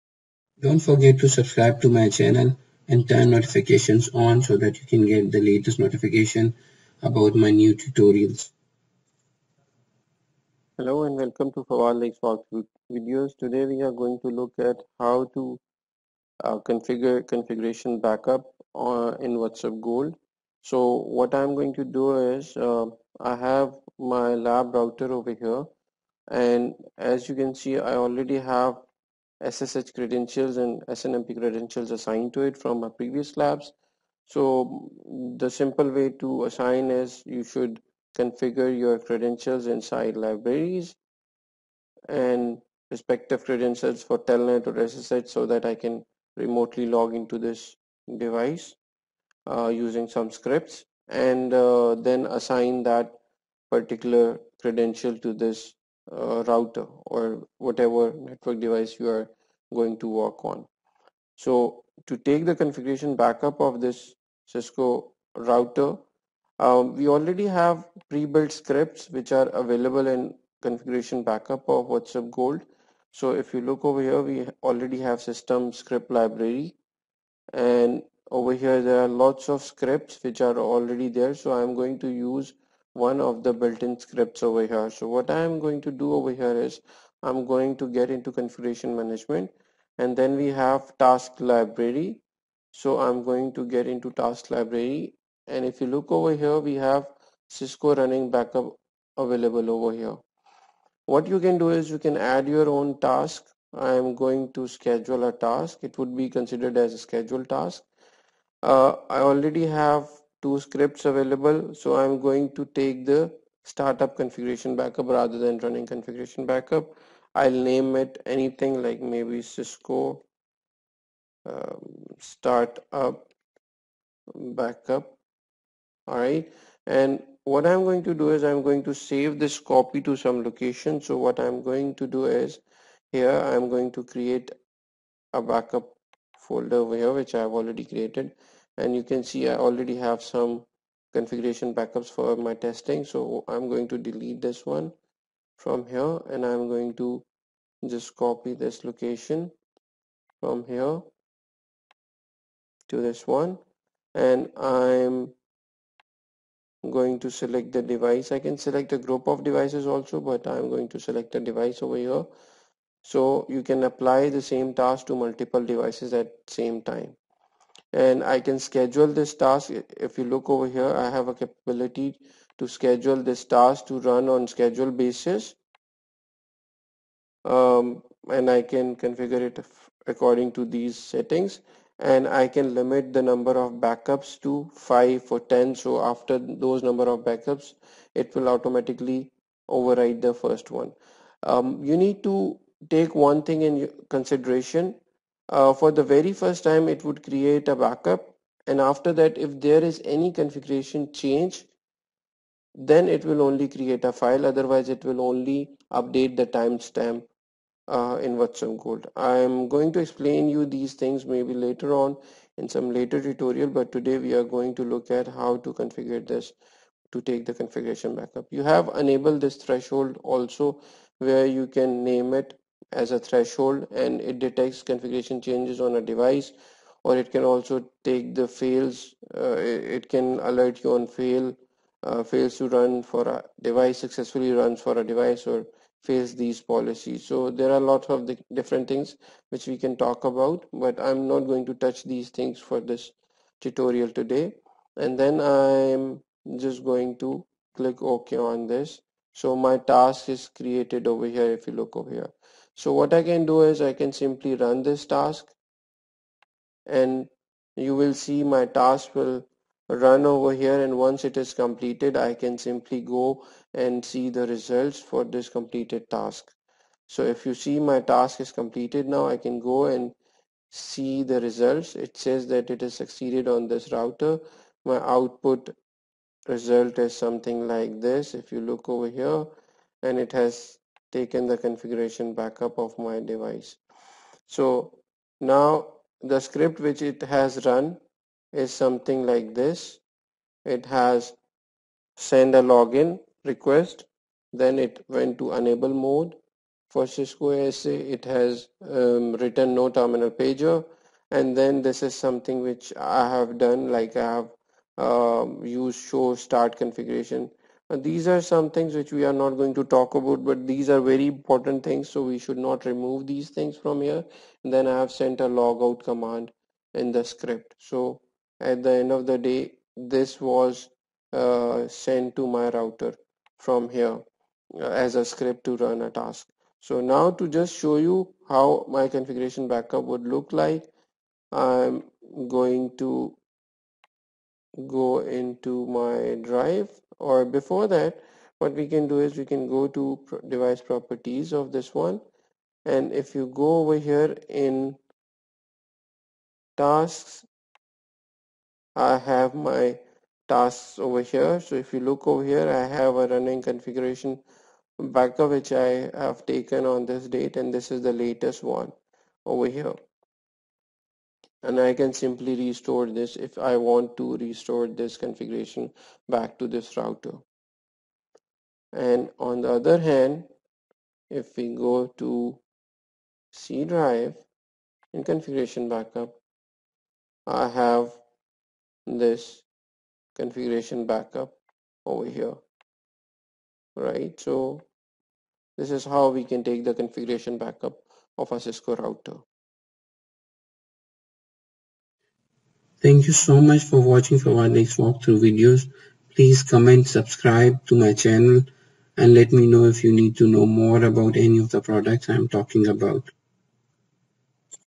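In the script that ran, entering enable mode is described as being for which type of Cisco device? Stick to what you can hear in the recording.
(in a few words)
Cisco ASA.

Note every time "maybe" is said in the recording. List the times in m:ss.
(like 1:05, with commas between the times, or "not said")
1:59, 3:31.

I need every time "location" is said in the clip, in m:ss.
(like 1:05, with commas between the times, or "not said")
2:10, 2:28.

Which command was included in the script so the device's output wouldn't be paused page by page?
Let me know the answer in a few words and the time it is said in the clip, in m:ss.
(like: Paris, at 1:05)
no terminal pager, at 4:59.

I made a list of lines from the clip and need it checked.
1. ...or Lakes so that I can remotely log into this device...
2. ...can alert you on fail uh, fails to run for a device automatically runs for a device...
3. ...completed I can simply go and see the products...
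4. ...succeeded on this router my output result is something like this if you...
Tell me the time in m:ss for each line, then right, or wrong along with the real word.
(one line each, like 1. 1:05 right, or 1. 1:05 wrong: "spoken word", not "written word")
1. 0:44 wrong: "SSH", not "Lakes"
2. 3:50 wrong: "successfully", not "automatically"
3. 4:21 wrong: "results", not "products"
4. 4:32 right.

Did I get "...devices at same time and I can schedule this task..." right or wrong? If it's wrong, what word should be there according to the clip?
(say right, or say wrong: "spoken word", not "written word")
right.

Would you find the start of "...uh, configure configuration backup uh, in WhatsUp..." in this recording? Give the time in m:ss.
0:16.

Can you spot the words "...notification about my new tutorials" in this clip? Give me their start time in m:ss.
0:05.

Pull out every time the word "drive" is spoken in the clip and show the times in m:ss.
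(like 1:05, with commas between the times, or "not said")
5:36, 6:13.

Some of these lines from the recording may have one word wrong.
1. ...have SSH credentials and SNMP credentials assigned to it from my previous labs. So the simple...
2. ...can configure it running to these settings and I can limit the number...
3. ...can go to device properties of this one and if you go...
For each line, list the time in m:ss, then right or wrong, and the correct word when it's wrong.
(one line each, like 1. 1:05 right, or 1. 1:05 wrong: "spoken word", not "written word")
1. 0:28 right
2. 2:58 wrong: "according", not "running"
3. 5:39 right.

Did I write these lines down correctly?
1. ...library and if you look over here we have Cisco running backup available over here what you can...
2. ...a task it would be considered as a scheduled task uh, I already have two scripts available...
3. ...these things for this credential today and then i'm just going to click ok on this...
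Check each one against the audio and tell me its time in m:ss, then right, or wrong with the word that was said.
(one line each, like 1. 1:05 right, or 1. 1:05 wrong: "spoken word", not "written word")
1. 1:34 right
2. 1:45 right
3. 4:02 wrong: "tutorial", not "credential".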